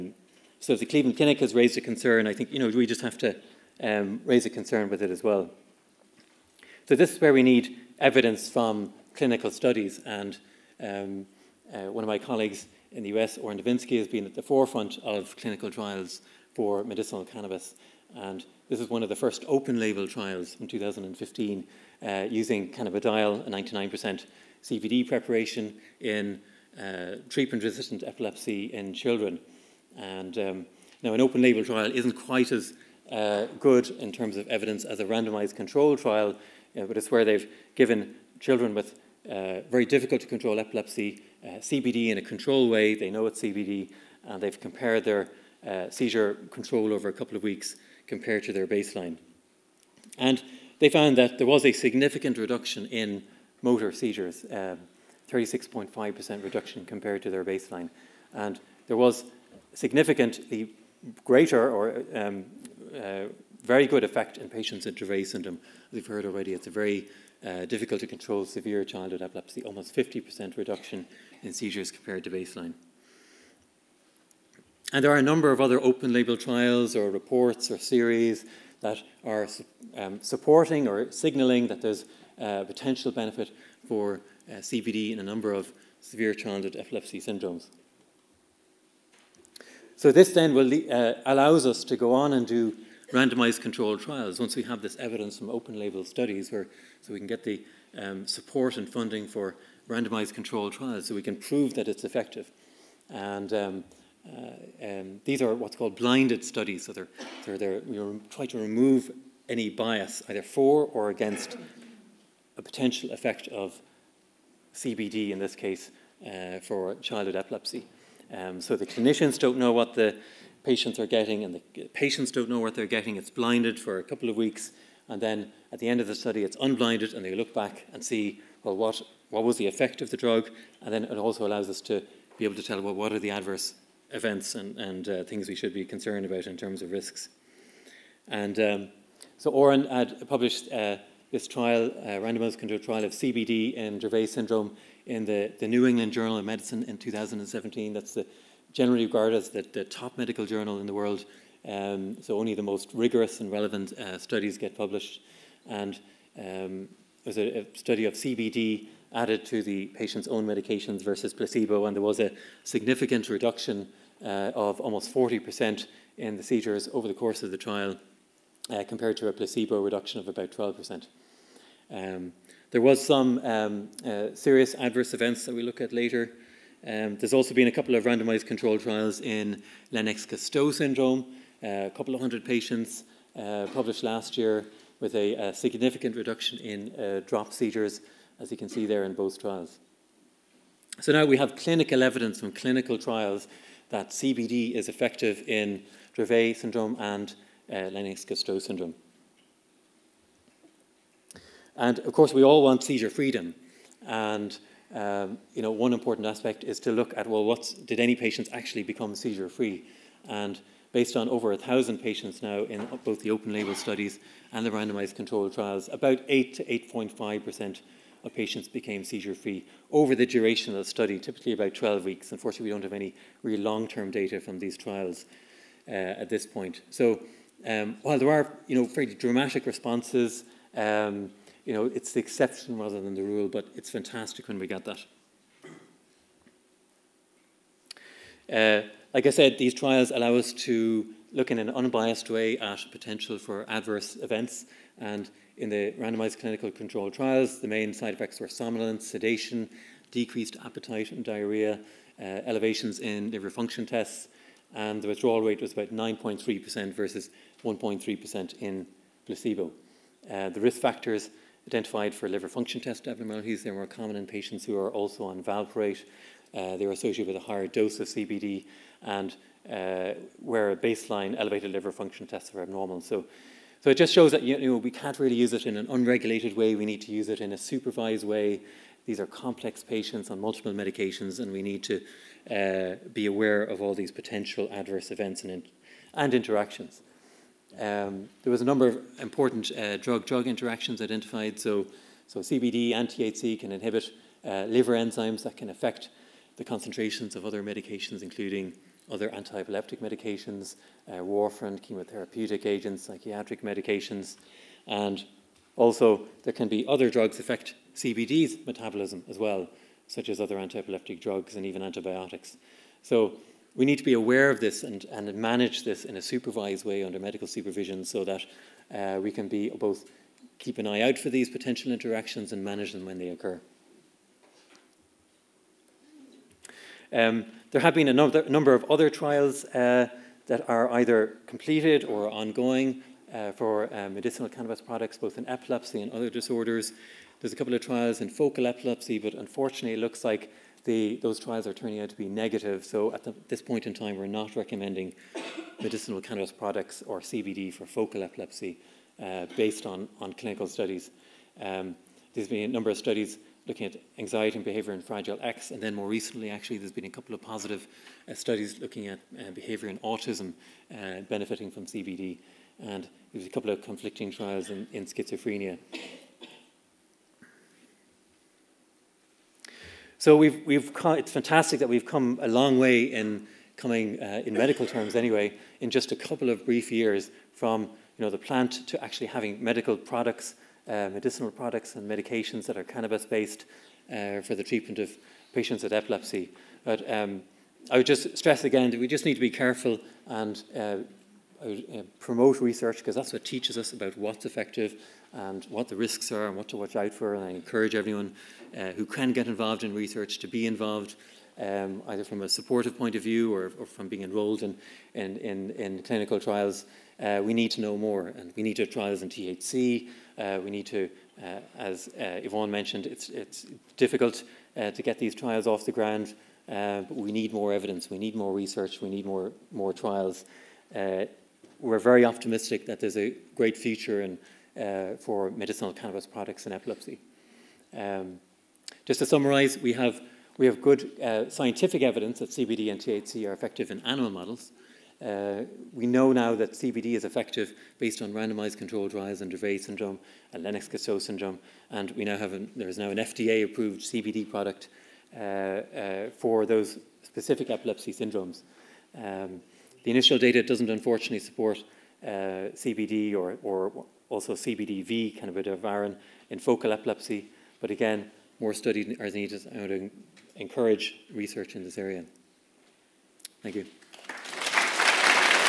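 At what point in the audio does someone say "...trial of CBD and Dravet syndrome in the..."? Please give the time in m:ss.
2:22.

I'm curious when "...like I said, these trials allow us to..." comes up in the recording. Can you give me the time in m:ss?
3:59.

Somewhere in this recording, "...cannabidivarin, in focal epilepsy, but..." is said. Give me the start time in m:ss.
7:35.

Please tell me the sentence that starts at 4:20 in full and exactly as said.
Uh, the risk factors identified for liver function test abnormalities, they more common in patients who are also on valproate.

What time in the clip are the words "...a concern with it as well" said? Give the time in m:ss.
0:04.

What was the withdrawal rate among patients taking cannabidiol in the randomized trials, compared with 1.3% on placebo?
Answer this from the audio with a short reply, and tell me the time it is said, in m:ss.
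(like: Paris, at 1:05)
9.3%, at 4:15.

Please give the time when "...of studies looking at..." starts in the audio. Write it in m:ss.
5:52.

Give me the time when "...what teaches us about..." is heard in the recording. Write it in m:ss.
6:33.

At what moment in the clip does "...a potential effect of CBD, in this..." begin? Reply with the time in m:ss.
1:52.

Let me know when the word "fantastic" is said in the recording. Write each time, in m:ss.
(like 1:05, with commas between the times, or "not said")
3:53, 6:11.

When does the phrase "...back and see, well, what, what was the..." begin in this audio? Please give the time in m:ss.
2:07.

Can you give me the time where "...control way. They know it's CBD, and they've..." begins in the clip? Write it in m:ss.
0:42.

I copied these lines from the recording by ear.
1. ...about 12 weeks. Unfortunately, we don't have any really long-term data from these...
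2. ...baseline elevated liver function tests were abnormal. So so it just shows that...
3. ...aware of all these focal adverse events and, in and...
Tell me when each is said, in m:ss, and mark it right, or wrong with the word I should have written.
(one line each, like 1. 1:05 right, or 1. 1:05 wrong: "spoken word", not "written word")
1. 3:41 right
2. 4:30 right
3. 4:43 wrong: "potential", not "focal".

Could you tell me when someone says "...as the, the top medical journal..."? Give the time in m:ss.
2:29.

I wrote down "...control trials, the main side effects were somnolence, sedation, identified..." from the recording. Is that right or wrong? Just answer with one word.
wrong.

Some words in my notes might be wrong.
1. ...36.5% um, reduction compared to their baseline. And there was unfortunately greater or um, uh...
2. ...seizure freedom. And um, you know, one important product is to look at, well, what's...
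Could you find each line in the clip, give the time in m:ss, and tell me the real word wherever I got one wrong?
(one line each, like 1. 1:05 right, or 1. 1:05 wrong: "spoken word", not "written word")
1. 0:54 wrong: "significantly", not "unfortunately"
2. 3:22 wrong: "aspect", not "product".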